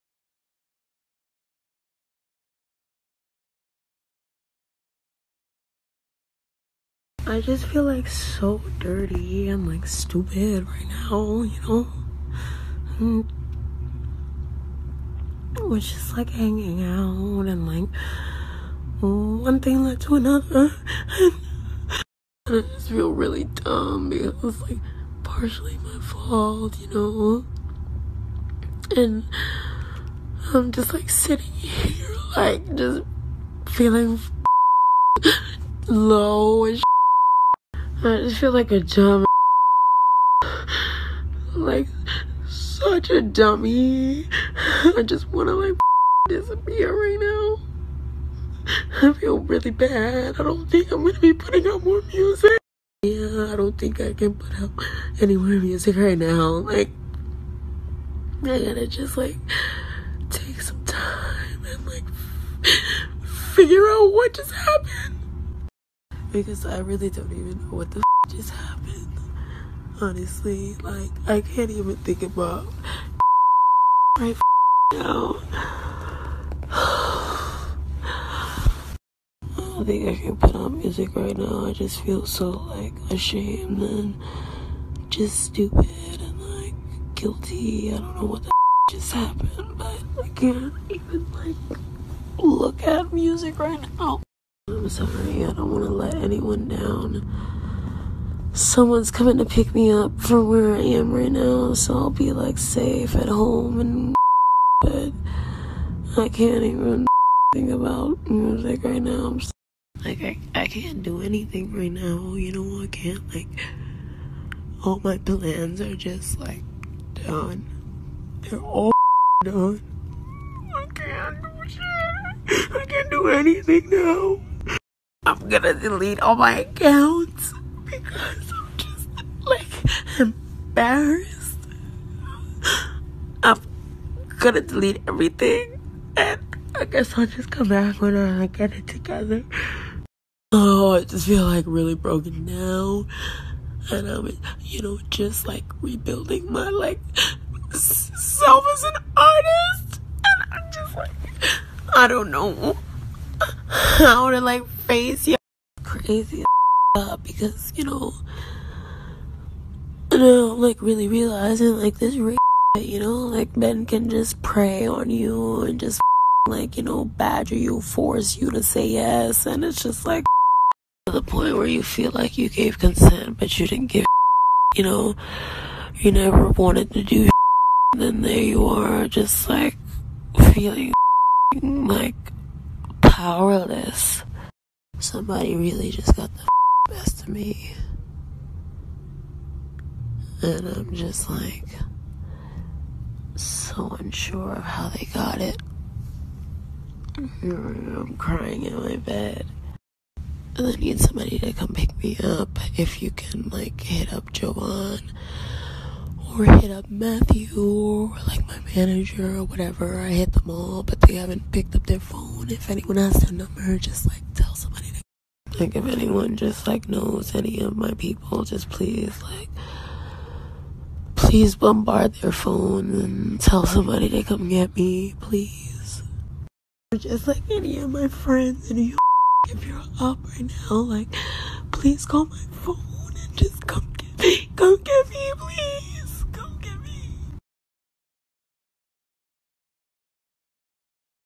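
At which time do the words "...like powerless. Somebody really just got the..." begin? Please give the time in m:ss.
3:01.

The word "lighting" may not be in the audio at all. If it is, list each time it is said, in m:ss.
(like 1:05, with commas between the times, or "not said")
not said.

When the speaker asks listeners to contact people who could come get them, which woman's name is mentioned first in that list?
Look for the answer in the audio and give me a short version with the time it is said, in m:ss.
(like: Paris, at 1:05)
Joanne, at 3:24.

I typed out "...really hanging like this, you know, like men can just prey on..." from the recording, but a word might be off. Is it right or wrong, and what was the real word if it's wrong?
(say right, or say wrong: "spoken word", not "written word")
wrong: "realizing", not "hanging".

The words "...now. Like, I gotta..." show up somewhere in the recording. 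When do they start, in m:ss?
0:56.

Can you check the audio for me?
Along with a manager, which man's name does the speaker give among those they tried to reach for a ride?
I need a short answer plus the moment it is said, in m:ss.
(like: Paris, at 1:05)
Matthew, at 3:26.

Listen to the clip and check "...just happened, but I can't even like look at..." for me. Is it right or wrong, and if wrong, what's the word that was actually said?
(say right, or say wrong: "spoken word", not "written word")
right.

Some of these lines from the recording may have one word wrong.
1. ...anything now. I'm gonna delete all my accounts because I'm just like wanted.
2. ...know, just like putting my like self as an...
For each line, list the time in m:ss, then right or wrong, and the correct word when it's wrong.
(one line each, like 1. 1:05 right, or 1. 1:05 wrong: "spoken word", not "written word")
1. 2:03 wrong: "embarrassed", not "wanted"
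2. 2:24 wrong: "rebuilding", not "putting".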